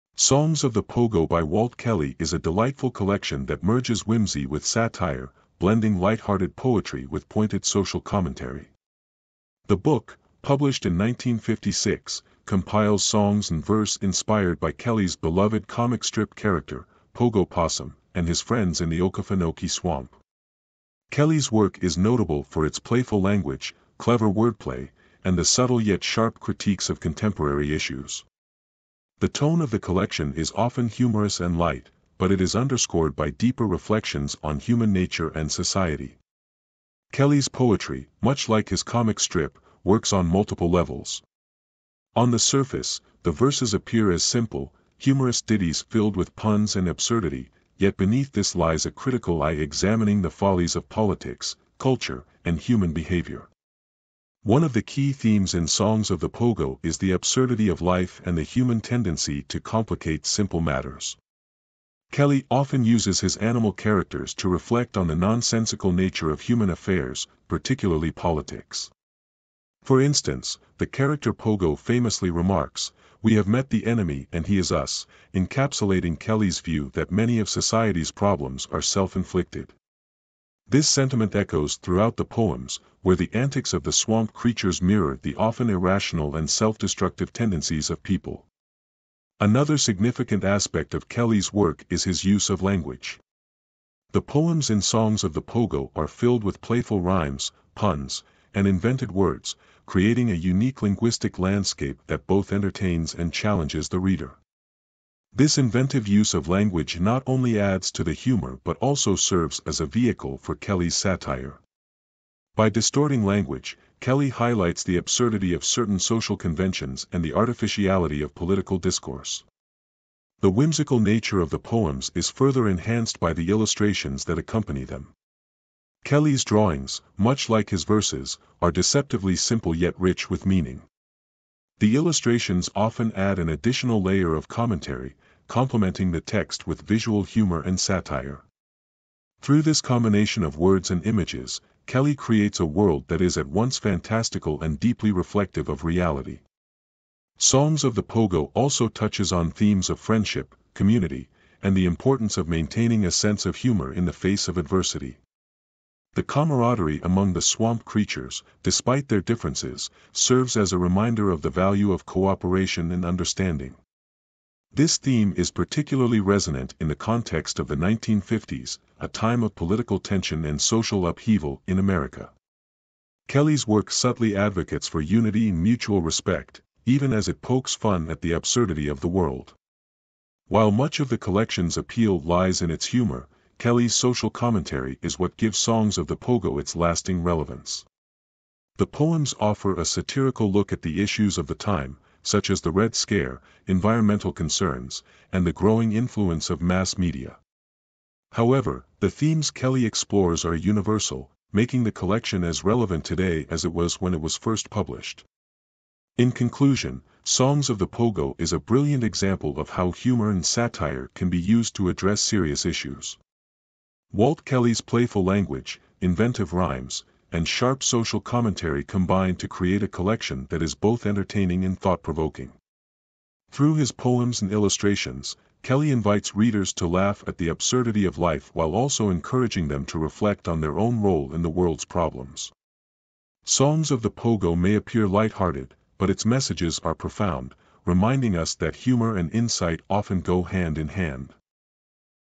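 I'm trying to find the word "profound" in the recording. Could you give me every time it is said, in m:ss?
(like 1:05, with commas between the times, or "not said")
3:56.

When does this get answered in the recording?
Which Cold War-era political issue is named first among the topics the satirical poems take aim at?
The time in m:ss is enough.
3:12.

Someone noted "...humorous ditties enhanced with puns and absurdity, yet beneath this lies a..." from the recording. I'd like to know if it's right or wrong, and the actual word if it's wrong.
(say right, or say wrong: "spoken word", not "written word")
wrong: "filled", not "enhanced".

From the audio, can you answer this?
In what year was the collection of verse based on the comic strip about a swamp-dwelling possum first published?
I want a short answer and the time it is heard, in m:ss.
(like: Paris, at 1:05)
1956, at 0:10.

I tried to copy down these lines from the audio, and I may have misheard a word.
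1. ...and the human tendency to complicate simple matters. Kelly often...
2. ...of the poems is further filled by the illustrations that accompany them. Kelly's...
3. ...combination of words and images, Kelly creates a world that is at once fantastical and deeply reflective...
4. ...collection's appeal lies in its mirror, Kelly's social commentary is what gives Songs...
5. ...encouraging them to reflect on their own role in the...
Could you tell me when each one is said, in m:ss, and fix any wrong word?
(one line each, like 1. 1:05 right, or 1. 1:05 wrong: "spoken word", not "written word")
1. 0:58 right
2. 2:01 wrong: "enhanced", not "filled"
3. 2:19 right
4. 3:01 wrong: "humor", not "mirror"
5. 3:49 right.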